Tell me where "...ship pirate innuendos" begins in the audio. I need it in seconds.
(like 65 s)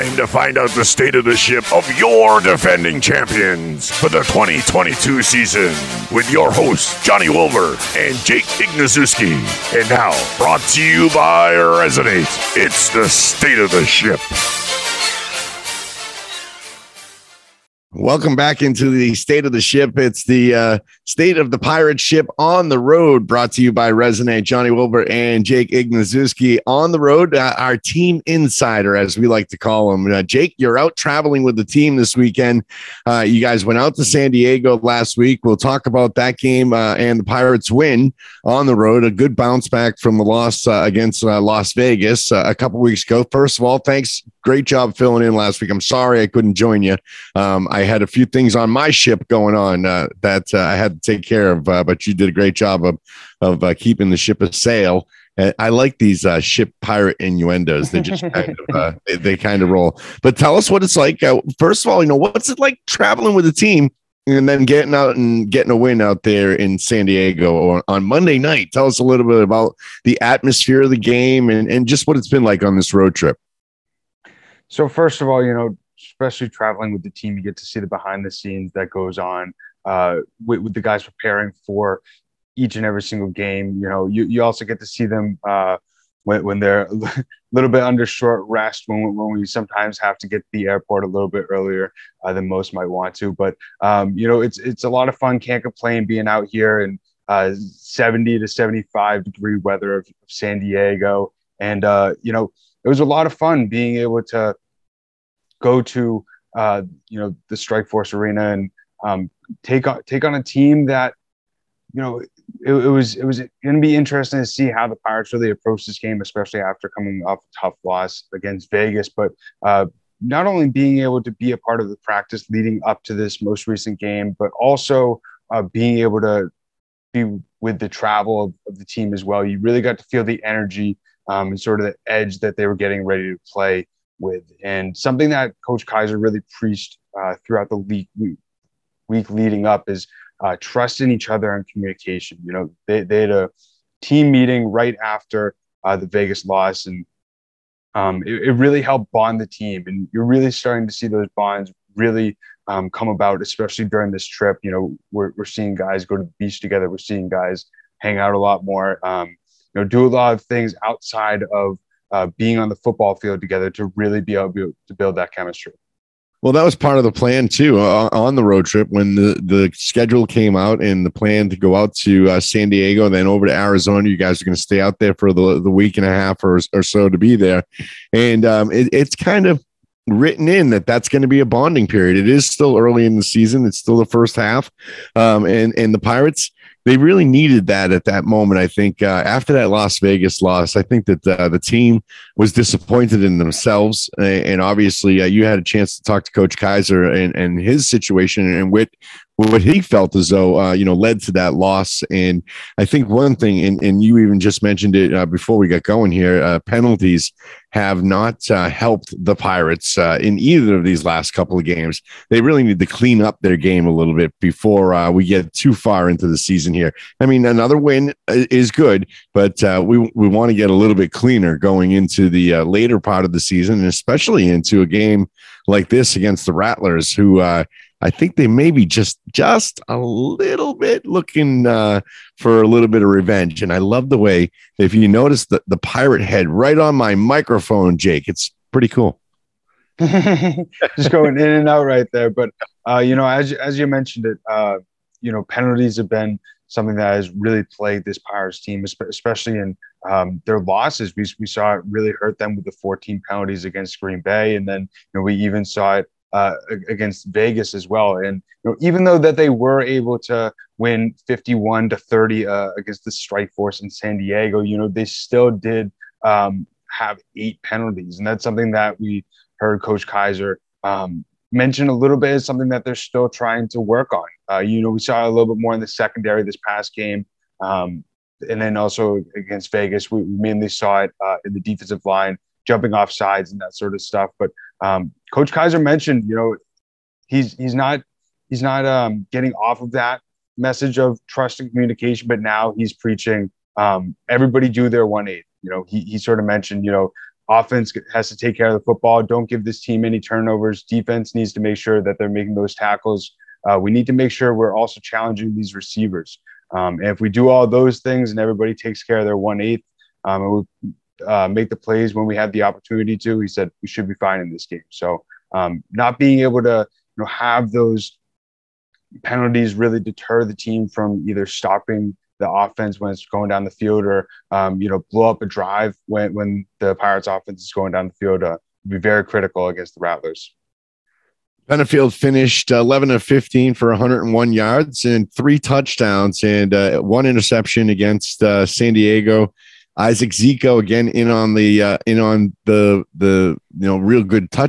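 56 s.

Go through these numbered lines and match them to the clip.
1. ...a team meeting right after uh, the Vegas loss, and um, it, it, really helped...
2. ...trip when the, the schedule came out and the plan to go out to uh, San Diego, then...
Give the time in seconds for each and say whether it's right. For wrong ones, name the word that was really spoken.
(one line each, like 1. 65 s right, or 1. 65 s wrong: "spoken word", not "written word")
1. 143 s right
2. 168 s right.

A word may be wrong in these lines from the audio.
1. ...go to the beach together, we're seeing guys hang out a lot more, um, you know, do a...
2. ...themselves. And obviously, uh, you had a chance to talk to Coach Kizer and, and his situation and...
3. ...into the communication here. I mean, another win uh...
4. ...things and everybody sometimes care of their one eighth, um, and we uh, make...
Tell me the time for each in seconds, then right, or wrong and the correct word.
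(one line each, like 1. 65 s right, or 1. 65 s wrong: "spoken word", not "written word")
1. 156 s right
2. 193 s right
3. 216 s wrong: "season", not "communication"
4. 308 s wrong: "takes", not "sometimes".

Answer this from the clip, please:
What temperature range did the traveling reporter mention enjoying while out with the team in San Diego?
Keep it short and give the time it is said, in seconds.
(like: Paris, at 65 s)
70 to 75 degrees, at 97 s.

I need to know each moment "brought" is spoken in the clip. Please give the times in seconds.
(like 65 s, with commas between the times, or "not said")
10 s, 23 s.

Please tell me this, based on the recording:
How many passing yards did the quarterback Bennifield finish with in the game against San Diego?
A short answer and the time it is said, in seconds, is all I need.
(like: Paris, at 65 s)
101 yards, at 333 s.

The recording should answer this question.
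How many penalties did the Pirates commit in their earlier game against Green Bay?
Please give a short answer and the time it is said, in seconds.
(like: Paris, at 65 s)
14, at 252 s.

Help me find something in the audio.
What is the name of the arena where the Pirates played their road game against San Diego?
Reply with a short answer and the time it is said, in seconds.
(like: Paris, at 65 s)
Strikeforce Arena, at 107 s.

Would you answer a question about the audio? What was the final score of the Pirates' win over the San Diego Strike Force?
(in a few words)
51 to 30.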